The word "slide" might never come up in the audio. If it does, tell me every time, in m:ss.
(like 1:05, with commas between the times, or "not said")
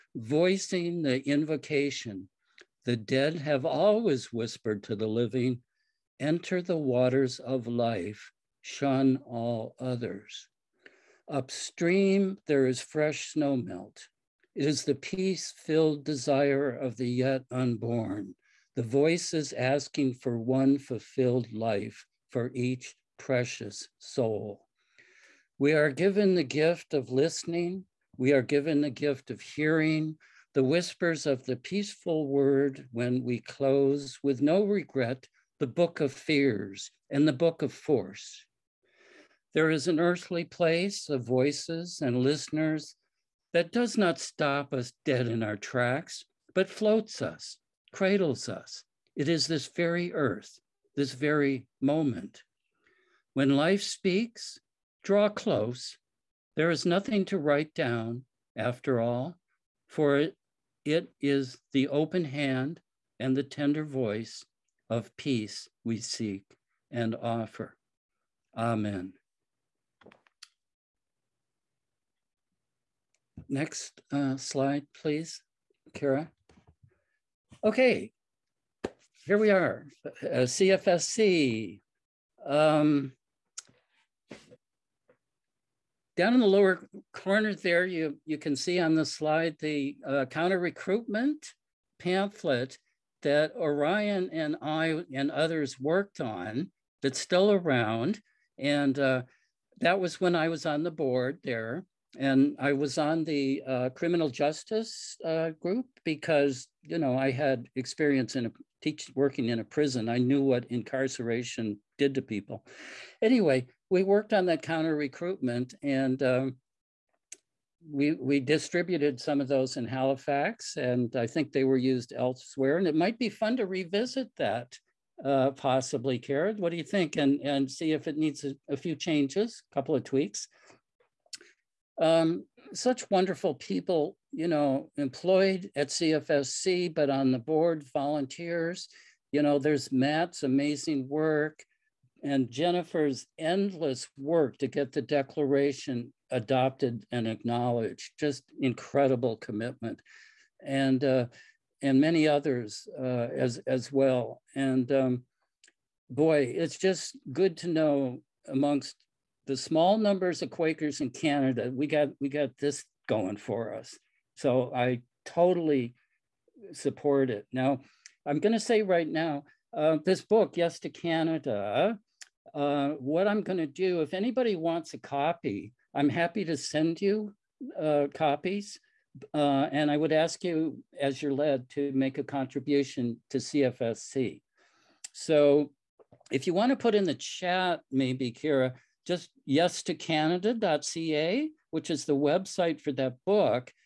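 1:14, 1:29.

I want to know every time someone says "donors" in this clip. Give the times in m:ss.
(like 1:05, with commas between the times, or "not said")
not said.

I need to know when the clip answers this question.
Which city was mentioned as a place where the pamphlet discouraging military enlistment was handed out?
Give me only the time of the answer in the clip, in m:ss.
1:59.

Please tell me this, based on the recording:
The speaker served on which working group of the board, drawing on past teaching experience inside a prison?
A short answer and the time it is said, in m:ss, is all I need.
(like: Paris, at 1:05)
criminal justice, at 1:43.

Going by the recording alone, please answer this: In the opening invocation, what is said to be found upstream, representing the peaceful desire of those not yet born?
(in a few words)
fresh snow melt.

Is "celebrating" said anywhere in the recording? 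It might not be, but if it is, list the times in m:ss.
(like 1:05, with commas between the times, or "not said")
not said.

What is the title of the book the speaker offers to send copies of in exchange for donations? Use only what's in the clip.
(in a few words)
Yes to Canada.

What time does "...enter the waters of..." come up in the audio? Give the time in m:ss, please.
0:06.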